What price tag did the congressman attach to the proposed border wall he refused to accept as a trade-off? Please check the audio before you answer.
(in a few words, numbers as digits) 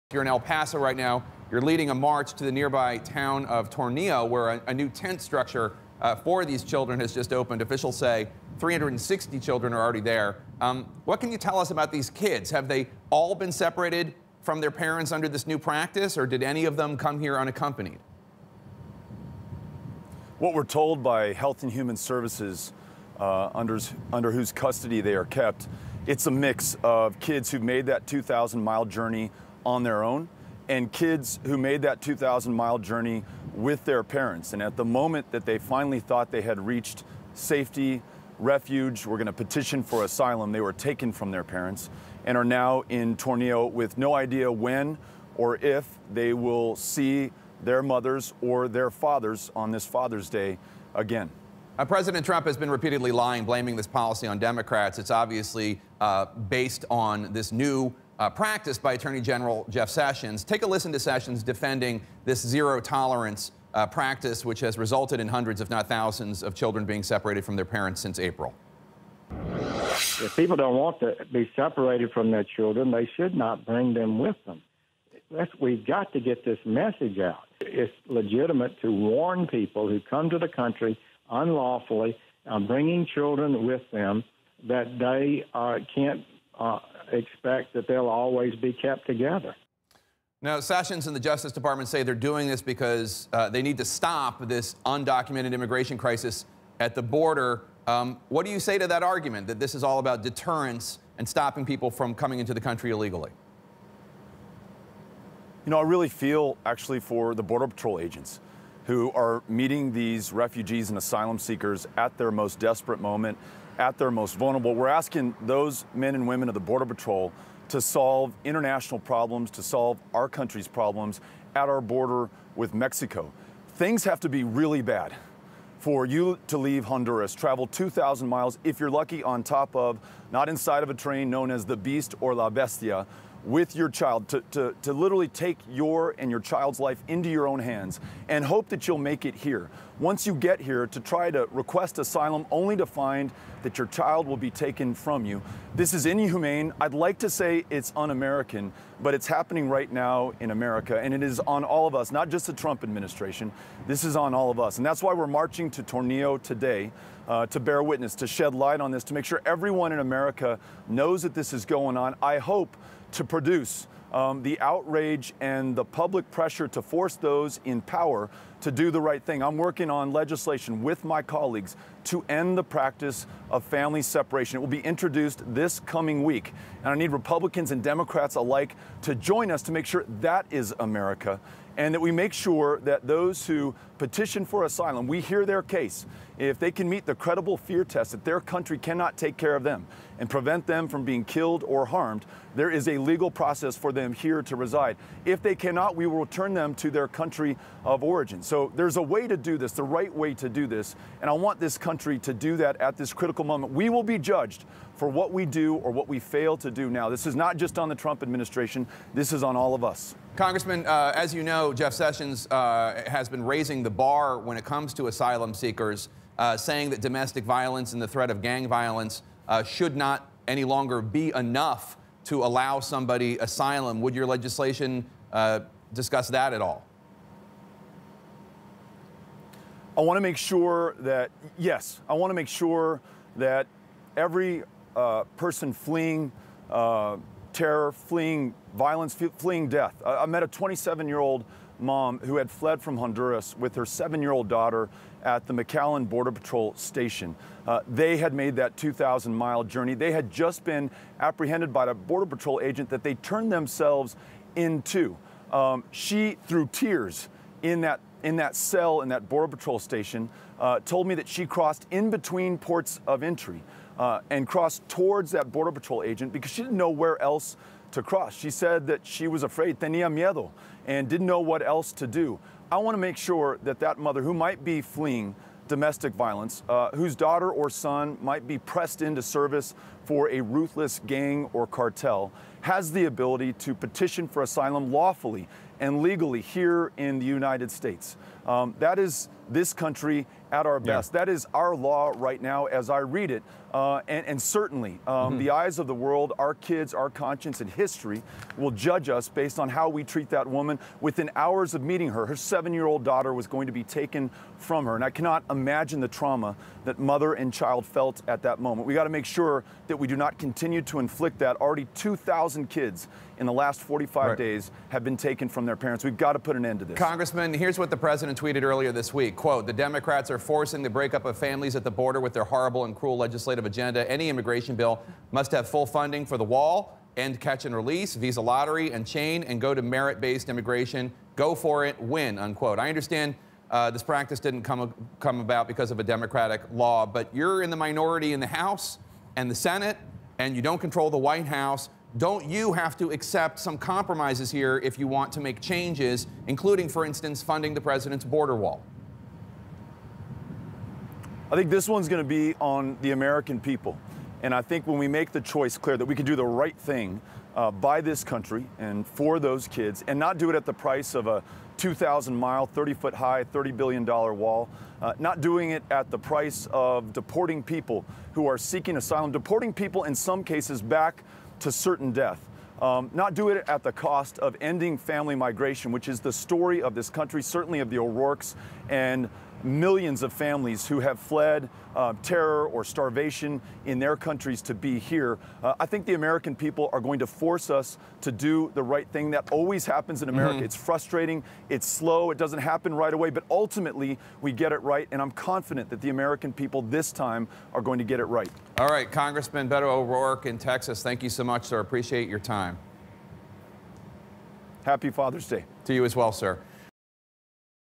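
$30 billion.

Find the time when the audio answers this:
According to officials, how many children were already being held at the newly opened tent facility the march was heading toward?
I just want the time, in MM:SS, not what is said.
00:08.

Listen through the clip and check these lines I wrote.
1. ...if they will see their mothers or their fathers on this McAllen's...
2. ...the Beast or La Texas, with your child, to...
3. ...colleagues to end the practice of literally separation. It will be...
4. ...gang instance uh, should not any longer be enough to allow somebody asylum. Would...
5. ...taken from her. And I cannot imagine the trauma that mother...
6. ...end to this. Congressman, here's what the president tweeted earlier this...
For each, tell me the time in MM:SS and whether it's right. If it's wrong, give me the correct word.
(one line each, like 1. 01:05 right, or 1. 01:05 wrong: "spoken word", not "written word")
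1. 00:45 wrong: "Father", not "McAllen"
2. 02:11 wrong: "Bestia", not "Texas"
3. 02:51 wrong: "family", not "literally"
4. 03:38 wrong: "violence", not "instance"
5. 05:03 right
6. 05:16 right.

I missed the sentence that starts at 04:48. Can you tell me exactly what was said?
Um, that is this country at our best.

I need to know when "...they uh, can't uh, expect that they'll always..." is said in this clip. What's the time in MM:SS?
01:24.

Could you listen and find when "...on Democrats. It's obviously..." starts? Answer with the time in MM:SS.
00:54.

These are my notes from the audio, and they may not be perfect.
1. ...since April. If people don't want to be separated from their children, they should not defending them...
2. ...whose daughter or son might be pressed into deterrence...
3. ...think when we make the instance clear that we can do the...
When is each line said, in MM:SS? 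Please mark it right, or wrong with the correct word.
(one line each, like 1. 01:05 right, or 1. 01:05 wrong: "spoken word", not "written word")
1. 01:07 wrong: "bring", not "defending"
2. 04:36 wrong: "service", not "deterrence"
3. 05:54 wrong: "choice", not "instance".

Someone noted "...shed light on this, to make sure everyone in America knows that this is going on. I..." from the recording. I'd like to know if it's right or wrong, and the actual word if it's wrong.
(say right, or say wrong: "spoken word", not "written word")
right.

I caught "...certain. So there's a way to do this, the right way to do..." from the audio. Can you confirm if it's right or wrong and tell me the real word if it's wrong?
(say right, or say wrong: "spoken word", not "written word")
wrong: "origin", not "certain".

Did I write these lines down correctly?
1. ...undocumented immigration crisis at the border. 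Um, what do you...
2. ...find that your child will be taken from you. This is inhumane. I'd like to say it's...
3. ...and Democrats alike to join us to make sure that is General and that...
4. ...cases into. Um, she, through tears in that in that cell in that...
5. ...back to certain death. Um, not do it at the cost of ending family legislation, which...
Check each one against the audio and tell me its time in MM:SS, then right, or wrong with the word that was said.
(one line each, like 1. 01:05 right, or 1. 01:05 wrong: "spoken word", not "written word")
1. 01:34 right
2. 02:22 right
3. 02:57 wrong: "America", not "General"
4. 04:13 wrong: "themselves", not "cases"
5. 06:10 wrong: "migration", not "legislation".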